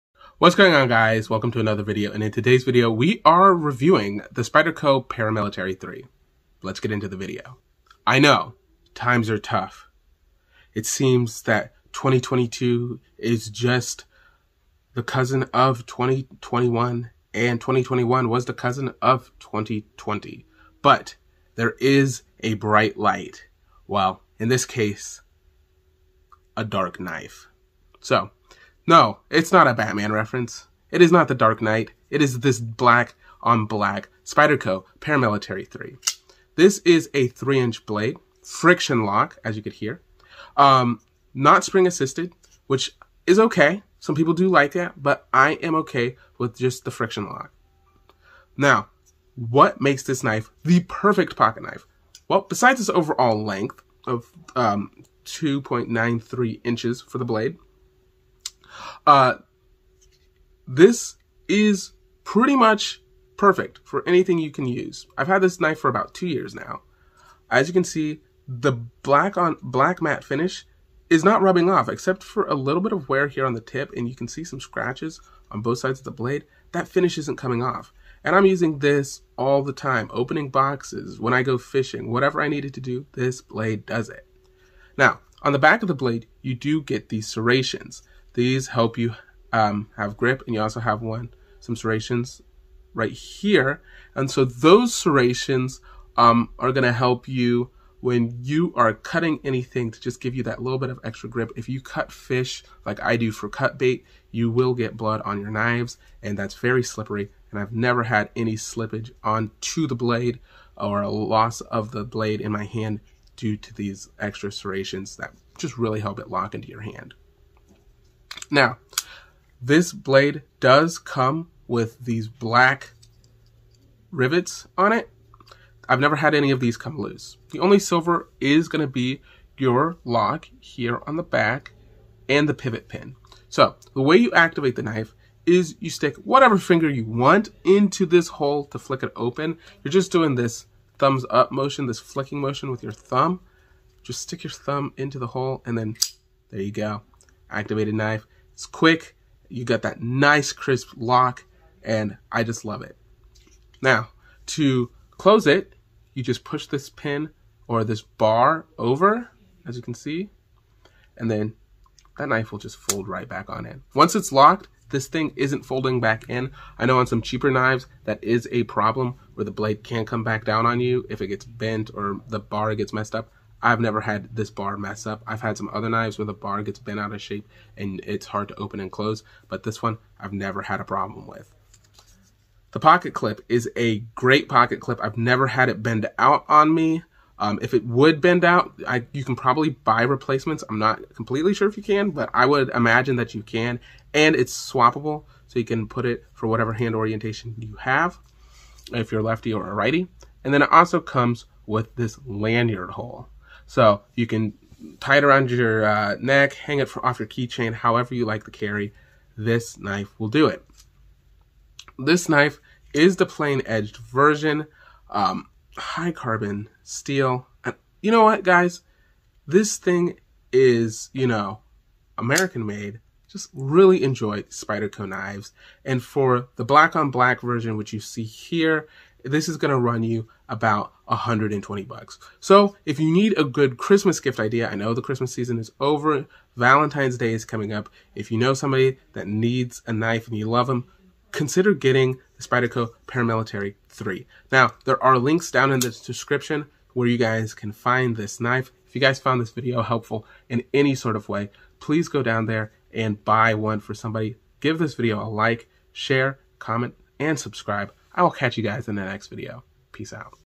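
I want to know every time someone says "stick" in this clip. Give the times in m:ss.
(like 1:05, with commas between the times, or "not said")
2:15, 2:24.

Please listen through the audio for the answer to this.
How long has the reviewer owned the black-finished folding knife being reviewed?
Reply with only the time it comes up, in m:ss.
1:05.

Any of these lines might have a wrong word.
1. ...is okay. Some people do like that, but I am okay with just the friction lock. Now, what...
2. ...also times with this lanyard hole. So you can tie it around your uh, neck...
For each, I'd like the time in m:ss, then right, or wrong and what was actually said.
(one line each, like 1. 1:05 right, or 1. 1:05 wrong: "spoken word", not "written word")
1. 0:43 right
2. 3:20 wrong: "comes", not "times".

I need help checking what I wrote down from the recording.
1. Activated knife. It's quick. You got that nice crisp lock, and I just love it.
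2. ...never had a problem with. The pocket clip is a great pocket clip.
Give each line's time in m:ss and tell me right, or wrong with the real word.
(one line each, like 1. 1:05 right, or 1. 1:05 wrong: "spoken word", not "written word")
1. 2:27 right
2. 3:00 right.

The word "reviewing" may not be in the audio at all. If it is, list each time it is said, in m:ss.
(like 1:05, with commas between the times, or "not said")
0:03.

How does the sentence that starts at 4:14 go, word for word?
Give this video a like, share, comment, and subscribe.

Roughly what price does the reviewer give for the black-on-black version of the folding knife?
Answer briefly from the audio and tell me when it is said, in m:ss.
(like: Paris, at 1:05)
$120, at 3:51.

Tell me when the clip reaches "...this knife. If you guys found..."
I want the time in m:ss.
4:08.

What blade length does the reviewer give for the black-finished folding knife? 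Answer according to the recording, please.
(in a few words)
2.93 inches.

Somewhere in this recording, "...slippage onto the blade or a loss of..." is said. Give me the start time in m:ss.
1:48.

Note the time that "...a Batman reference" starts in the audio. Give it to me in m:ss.
0:29.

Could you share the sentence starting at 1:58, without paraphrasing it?
Now, this blade does come with these black rivets on it.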